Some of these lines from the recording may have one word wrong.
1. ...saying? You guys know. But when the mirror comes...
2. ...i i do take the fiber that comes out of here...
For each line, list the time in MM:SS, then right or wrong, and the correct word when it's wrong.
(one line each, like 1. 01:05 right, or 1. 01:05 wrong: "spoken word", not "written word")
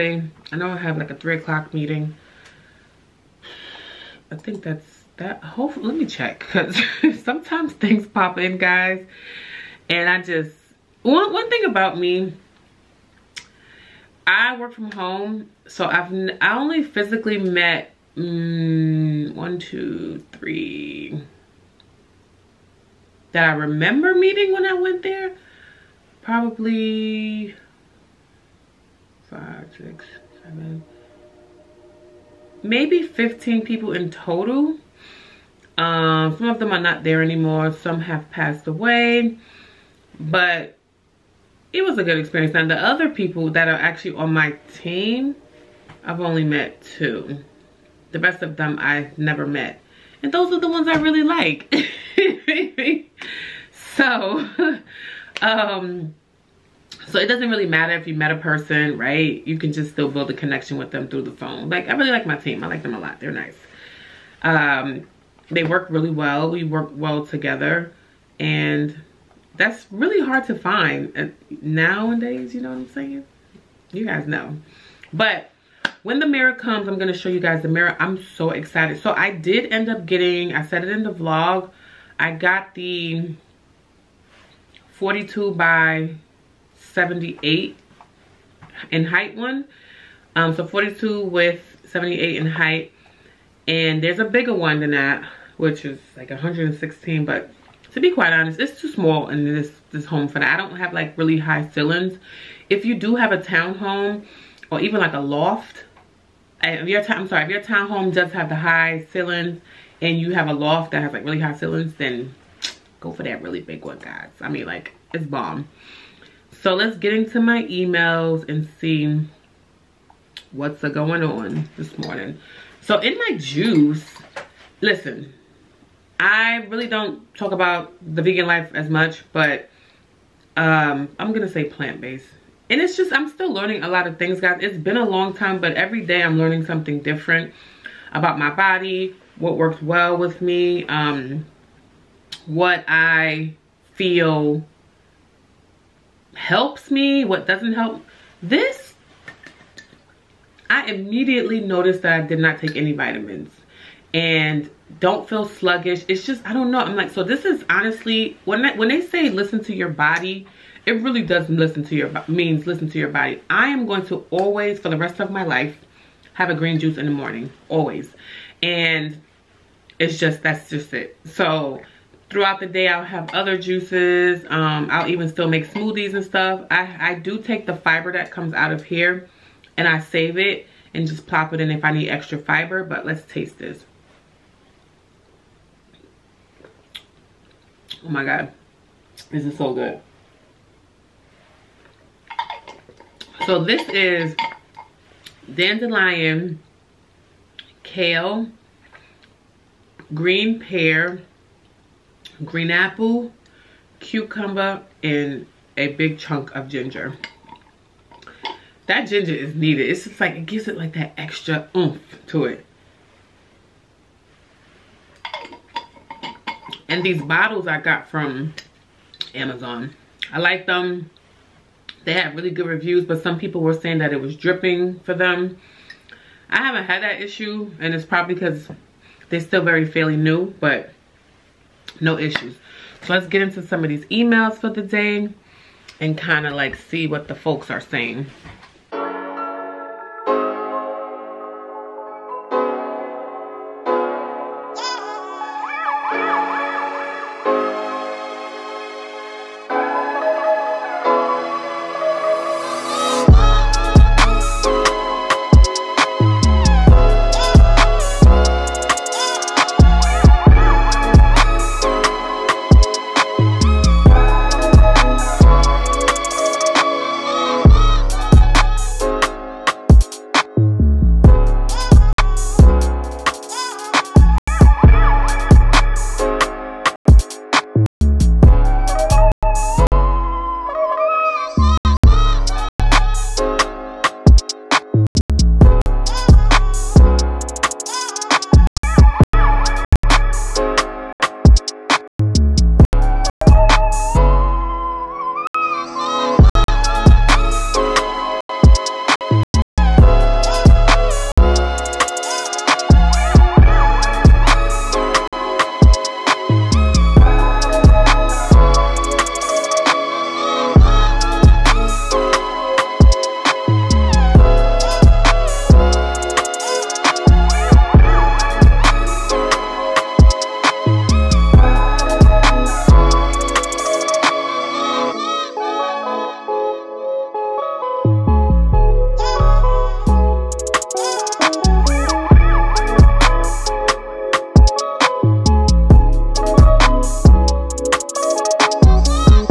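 1. 01:12 right
2. 02:56 right.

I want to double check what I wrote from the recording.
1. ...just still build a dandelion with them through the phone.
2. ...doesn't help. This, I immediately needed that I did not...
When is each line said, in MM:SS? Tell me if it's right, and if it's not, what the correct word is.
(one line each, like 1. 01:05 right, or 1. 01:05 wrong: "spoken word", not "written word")
1. 00:59 wrong: "connection", not "dandelion"
2. 02:27 wrong: "noticed", not "needed".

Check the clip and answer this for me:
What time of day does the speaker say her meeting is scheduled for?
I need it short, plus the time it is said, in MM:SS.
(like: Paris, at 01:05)
3 o'clock, at 00:01.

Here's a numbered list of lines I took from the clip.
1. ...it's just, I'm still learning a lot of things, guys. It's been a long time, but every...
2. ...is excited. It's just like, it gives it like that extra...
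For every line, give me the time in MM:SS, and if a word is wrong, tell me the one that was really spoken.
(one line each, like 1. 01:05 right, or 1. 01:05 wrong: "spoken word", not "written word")
1. 02:12 right
2. 03:29 wrong: "needed", not "excited".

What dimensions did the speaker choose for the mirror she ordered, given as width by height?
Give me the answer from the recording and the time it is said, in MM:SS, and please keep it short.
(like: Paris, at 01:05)
42 by 78, at 01:24.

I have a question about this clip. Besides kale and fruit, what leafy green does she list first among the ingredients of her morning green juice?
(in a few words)
Dandelion.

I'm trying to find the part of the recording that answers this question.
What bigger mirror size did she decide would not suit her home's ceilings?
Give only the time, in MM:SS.
01:36.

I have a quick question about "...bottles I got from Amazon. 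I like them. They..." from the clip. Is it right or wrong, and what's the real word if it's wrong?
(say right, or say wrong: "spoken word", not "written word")
right.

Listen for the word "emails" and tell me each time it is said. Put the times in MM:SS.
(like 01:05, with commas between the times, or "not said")
01:57, 03:54.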